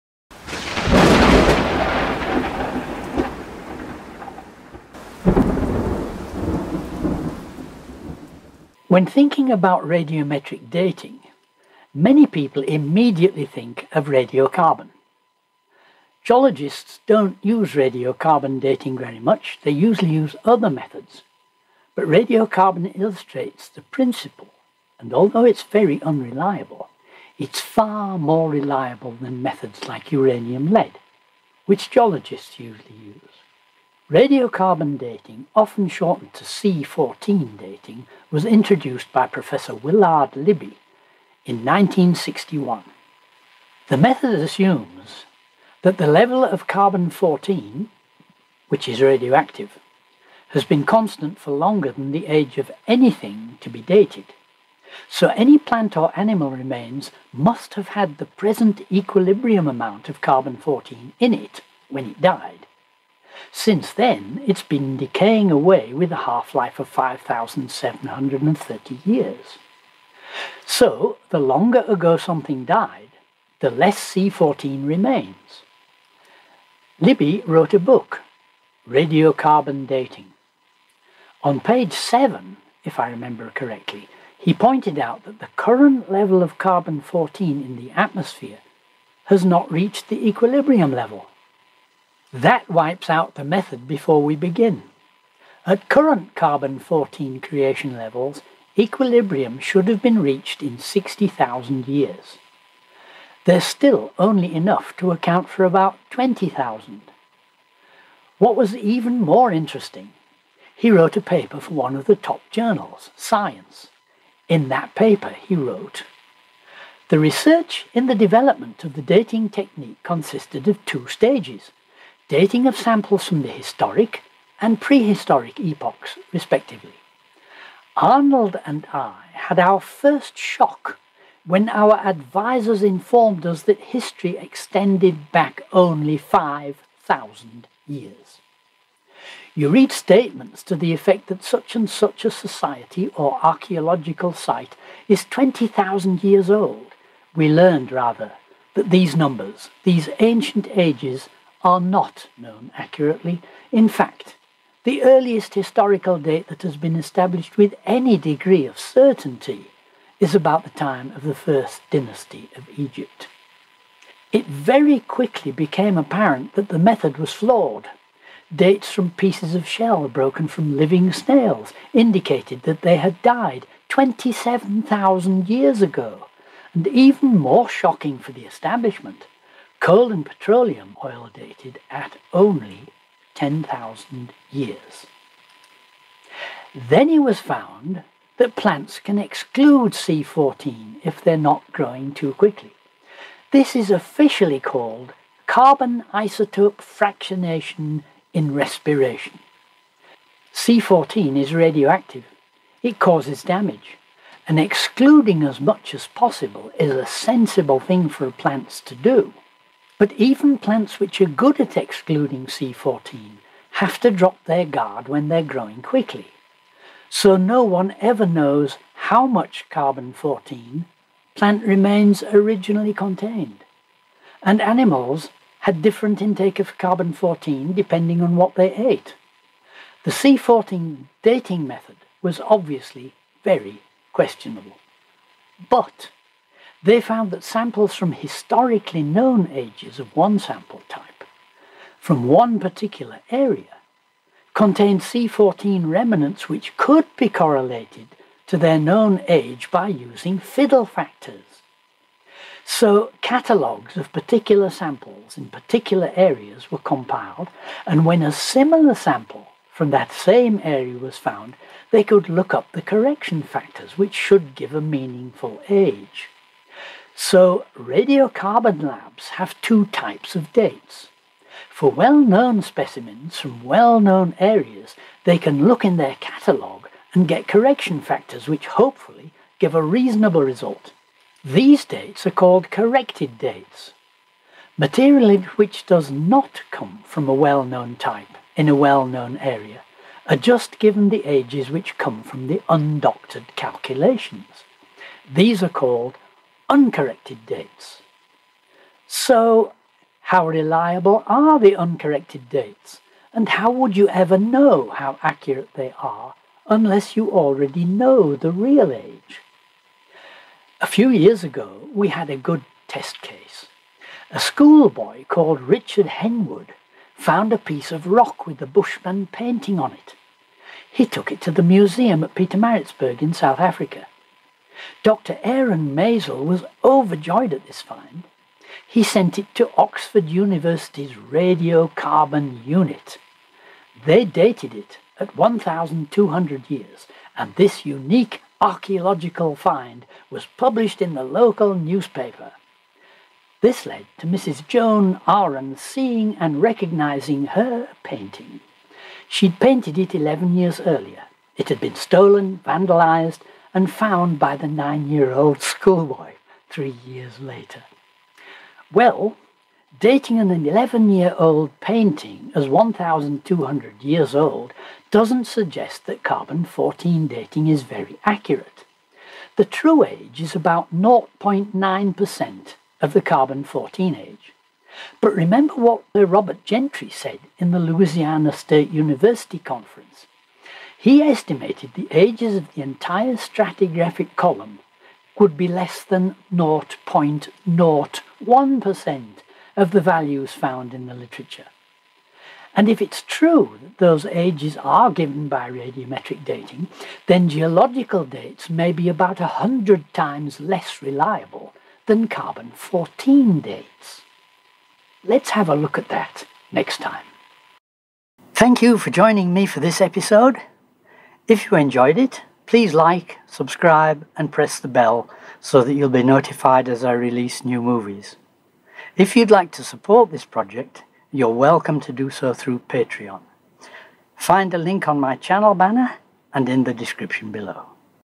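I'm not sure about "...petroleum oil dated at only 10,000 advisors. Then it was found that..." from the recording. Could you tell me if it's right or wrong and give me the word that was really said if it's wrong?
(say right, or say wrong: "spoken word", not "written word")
wrong: "years", not "advisors".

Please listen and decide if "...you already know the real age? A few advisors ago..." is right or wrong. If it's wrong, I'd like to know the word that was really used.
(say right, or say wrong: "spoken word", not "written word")
wrong: "years", not "advisors".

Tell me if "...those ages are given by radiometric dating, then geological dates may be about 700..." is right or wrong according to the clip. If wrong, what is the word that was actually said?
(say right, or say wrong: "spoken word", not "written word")
wrong: "100", not "700".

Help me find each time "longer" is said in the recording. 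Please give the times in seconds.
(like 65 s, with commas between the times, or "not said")
51 s, 71 s.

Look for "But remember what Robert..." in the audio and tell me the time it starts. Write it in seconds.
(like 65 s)
375 s.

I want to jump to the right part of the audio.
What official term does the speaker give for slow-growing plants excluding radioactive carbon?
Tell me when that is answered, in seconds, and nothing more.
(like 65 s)
195 s.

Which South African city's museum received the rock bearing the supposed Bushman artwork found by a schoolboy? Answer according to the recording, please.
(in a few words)
Pietermaritzburg.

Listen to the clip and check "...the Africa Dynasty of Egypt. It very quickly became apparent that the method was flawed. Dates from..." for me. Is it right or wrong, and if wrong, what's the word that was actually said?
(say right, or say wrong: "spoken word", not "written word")
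wrong: "First", not "Africa".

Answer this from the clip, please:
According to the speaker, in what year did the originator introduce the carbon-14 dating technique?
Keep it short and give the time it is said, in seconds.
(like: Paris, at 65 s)
1961, at 41 s.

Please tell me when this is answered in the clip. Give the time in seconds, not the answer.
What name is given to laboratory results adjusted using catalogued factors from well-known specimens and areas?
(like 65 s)
282 s.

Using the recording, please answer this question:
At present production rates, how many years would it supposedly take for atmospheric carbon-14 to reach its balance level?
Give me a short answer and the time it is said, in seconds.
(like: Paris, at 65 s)
60,000 years, at 100 s.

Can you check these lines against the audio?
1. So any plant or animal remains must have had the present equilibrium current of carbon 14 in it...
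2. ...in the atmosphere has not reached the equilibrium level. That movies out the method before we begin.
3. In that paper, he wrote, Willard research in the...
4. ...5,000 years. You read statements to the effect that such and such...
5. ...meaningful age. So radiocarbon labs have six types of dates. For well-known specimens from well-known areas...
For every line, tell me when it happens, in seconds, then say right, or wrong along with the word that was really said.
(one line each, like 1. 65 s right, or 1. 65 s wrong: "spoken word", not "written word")
1. 55 s wrong: "amount", not "current"
2. 87 s wrong: "wipes", not "movies"
3. 114 s wrong: "The", not "Willard"
4. 136 s right
5. 264 s wrong: "two", not "six".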